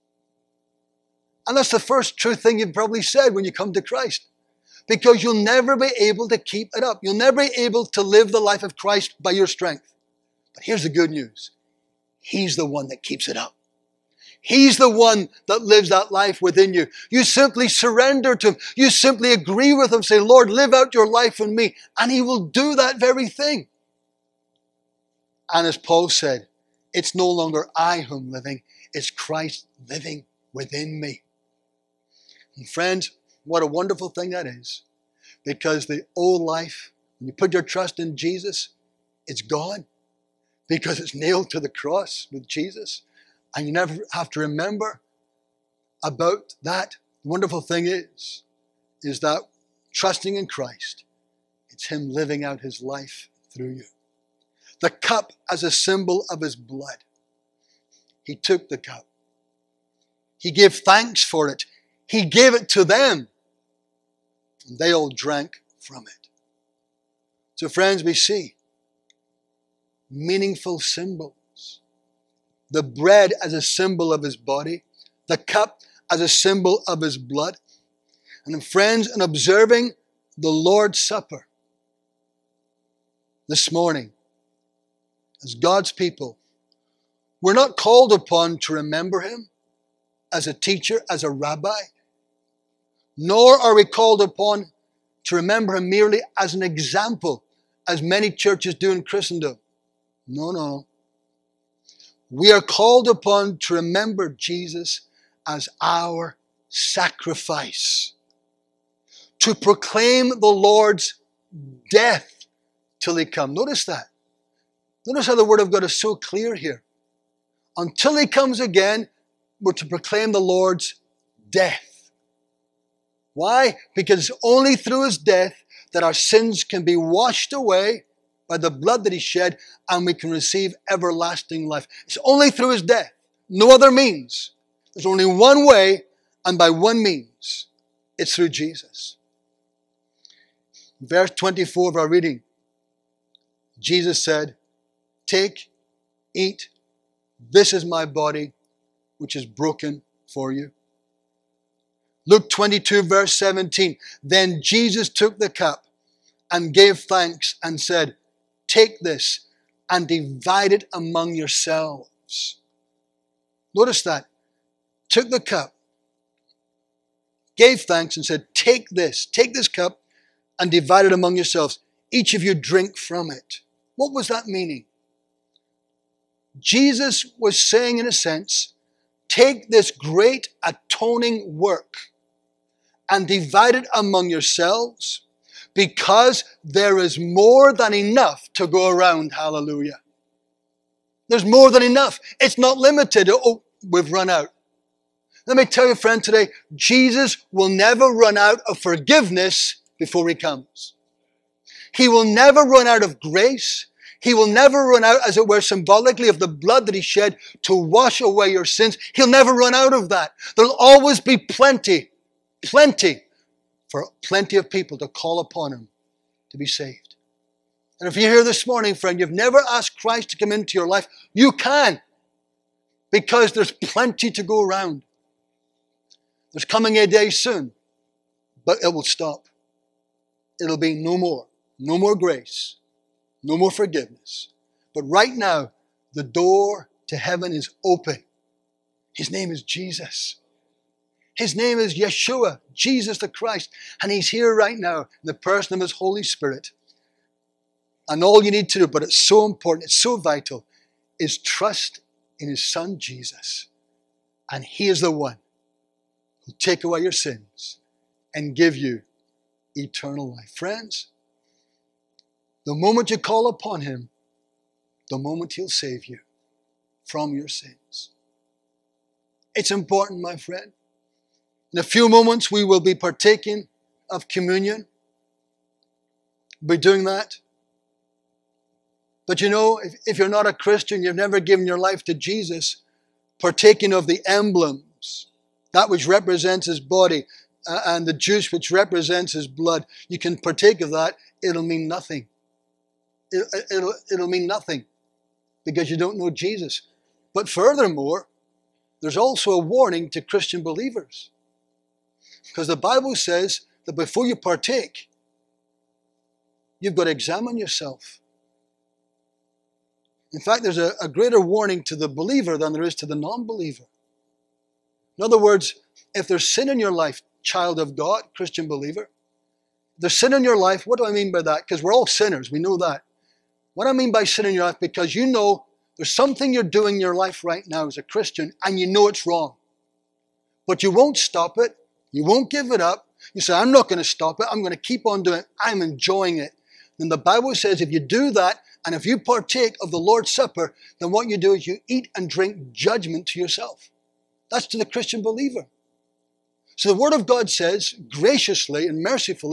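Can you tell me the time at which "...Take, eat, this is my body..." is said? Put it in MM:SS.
02:25.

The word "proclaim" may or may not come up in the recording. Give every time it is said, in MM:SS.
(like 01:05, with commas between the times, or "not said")
01:49, 01:59.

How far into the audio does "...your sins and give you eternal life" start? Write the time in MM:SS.
04:16.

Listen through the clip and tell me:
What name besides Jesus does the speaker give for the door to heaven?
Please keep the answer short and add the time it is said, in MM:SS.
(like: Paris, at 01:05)
Yeshua, at 04:01.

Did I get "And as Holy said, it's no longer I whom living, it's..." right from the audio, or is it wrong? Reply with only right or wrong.
wrong.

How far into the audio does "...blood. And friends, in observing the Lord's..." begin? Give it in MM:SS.
01:17.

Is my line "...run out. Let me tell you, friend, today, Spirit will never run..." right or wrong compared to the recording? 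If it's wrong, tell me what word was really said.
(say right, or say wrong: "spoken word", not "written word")
wrong: "Jesus", not "Spirit".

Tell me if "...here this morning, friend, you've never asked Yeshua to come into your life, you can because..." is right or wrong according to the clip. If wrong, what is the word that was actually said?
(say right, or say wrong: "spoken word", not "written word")
wrong: "Christ", not "Yeshua".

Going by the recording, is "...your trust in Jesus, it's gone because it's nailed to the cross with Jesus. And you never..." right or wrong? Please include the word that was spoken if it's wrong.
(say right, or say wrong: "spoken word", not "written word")
right.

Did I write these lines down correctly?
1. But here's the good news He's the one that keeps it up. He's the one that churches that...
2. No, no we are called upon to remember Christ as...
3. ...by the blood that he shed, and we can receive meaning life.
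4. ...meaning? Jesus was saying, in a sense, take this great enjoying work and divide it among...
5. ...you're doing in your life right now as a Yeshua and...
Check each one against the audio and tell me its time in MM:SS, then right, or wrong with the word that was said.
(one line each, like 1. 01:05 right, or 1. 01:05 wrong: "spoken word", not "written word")
1. 00:10 wrong: "lives", not "churches"
2. 01:40 wrong: "Jesus", not "Christ"
3. 02:08 wrong: "everlasting", not "meaning"
4. 02:54 wrong: "atoning", not "enjoying"
5. 05:26 wrong: "Christian", not "Yeshua".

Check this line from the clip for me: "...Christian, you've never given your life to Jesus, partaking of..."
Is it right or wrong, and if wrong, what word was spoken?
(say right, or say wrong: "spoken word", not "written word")
right.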